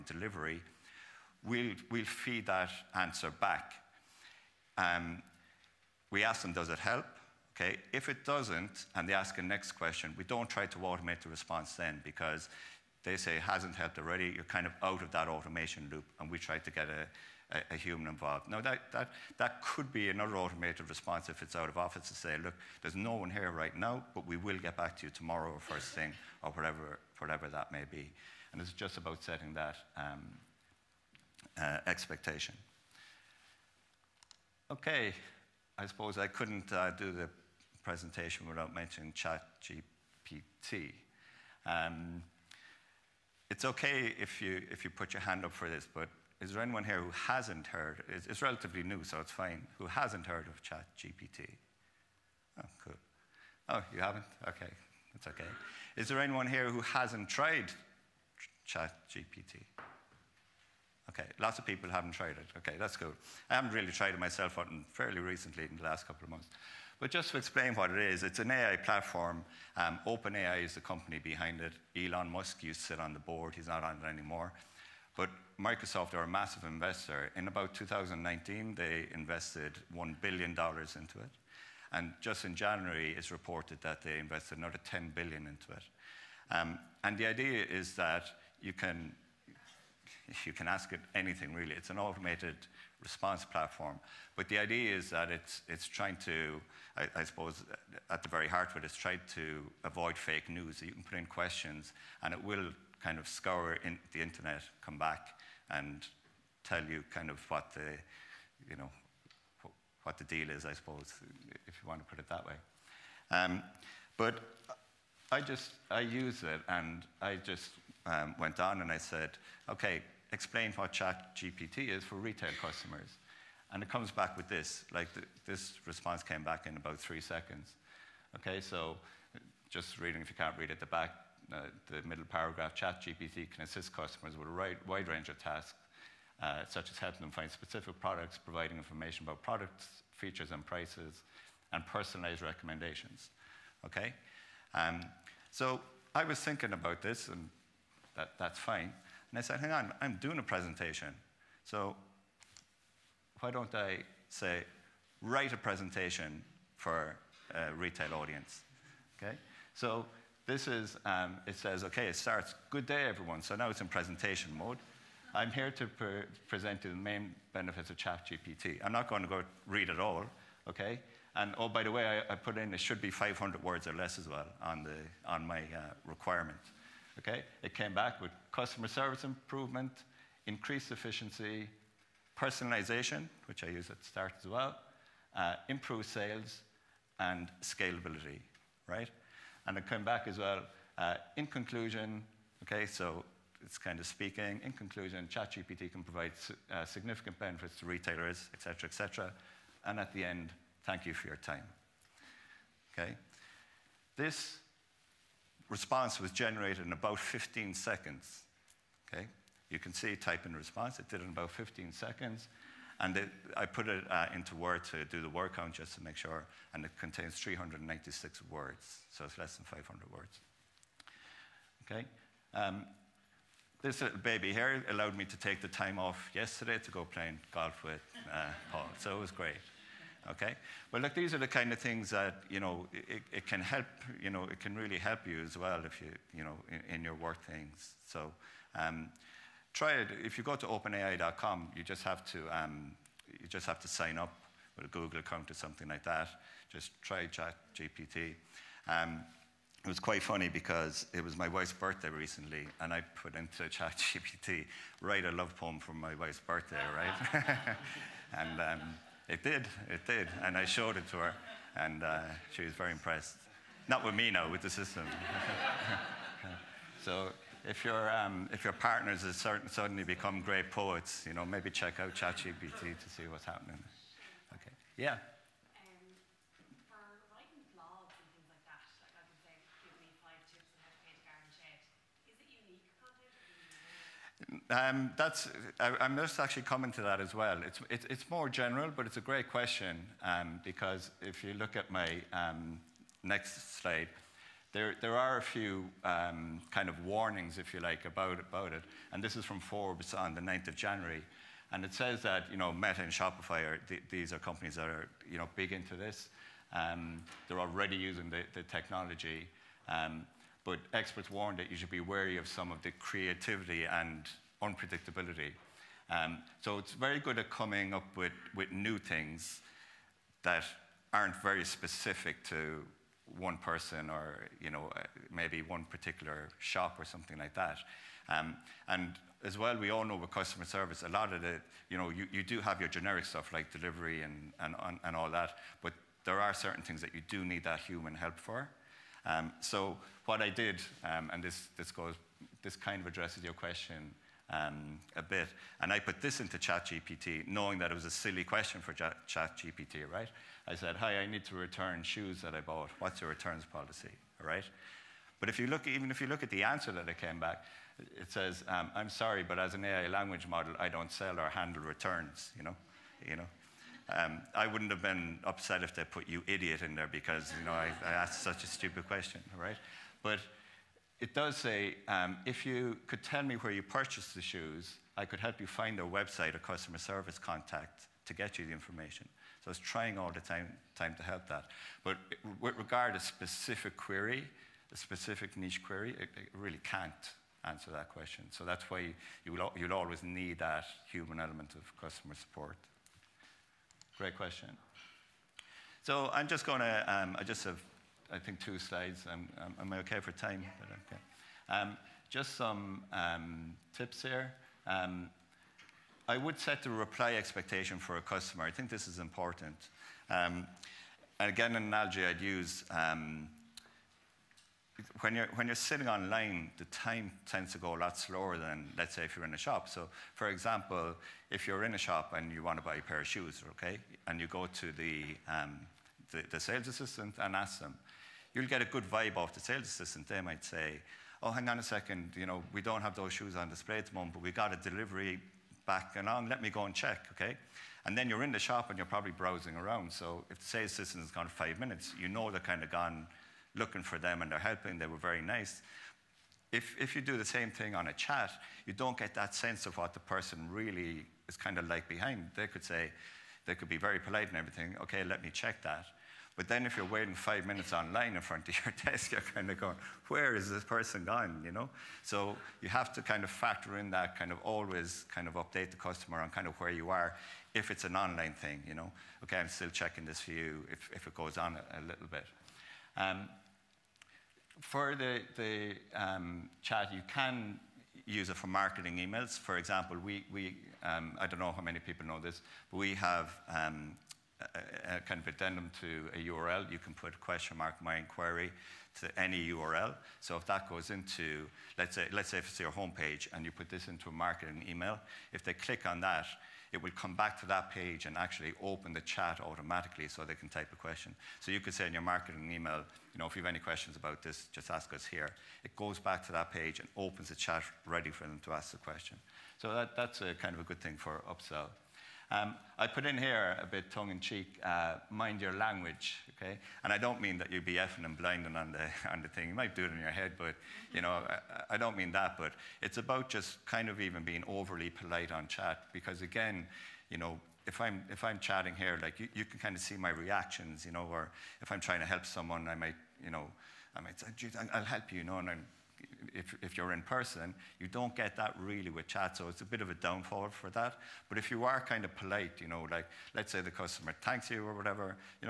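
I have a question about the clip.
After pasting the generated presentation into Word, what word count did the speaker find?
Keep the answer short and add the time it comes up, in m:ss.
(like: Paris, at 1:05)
396, at 3:37.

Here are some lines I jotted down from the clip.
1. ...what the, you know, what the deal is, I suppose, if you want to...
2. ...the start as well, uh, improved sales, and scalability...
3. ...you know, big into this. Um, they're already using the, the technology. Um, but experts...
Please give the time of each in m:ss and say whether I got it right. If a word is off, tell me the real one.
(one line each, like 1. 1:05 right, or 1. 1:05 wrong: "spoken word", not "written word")
1. 1:47 right
2. 3:03 right
3. 5:05 right.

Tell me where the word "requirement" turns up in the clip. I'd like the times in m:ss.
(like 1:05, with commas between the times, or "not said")
2:56.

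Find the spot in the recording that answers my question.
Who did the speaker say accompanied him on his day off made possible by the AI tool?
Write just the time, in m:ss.
3:48.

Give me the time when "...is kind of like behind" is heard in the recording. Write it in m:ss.
7:31.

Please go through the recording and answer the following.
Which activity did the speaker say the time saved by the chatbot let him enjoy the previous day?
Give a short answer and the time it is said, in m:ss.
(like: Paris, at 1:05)
golf, at 3:47.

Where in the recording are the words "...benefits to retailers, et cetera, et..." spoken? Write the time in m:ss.
3:17.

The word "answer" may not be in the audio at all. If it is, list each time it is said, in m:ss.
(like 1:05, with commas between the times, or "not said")
0:02, 5:56, 6:27.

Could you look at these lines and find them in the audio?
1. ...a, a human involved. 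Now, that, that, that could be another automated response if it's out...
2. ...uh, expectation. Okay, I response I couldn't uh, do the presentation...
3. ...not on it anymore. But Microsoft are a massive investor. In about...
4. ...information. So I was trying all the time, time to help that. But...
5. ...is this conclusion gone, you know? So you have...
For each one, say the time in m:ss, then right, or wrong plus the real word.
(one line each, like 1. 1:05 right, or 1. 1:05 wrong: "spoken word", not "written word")
1. 0:17 right
2. 0:31 wrong: "suppose", not "response"
3. 1:13 right
4. 6:18 right
5. 7:40 wrong: "person", not "conclusion".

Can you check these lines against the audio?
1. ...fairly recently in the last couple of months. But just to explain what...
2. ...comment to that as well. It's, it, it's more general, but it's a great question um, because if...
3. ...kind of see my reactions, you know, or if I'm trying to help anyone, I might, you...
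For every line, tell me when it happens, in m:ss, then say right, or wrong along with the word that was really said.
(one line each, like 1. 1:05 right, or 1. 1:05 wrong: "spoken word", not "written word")
1. 1:04 right
2. 4:46 right
3. 8:49 wrong: "someone", not "anyone".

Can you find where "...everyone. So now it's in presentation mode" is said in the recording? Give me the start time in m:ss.
2:43.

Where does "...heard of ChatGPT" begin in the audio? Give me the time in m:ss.
0:50.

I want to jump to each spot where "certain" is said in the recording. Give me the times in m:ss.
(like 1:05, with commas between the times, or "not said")
4:29, 5:36.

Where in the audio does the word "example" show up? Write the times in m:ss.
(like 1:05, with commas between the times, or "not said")
7:00, 7:59.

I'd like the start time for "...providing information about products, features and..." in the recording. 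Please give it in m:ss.
2:18.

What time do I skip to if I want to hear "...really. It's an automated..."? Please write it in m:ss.
1:31.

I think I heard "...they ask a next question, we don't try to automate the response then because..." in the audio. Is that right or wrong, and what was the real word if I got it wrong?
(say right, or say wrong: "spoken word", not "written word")
right.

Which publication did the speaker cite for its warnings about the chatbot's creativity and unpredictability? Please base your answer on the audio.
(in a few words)
Forbes.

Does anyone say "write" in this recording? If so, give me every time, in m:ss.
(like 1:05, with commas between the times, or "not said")
2:35, 4:14.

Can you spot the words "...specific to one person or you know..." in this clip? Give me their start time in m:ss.
5:21.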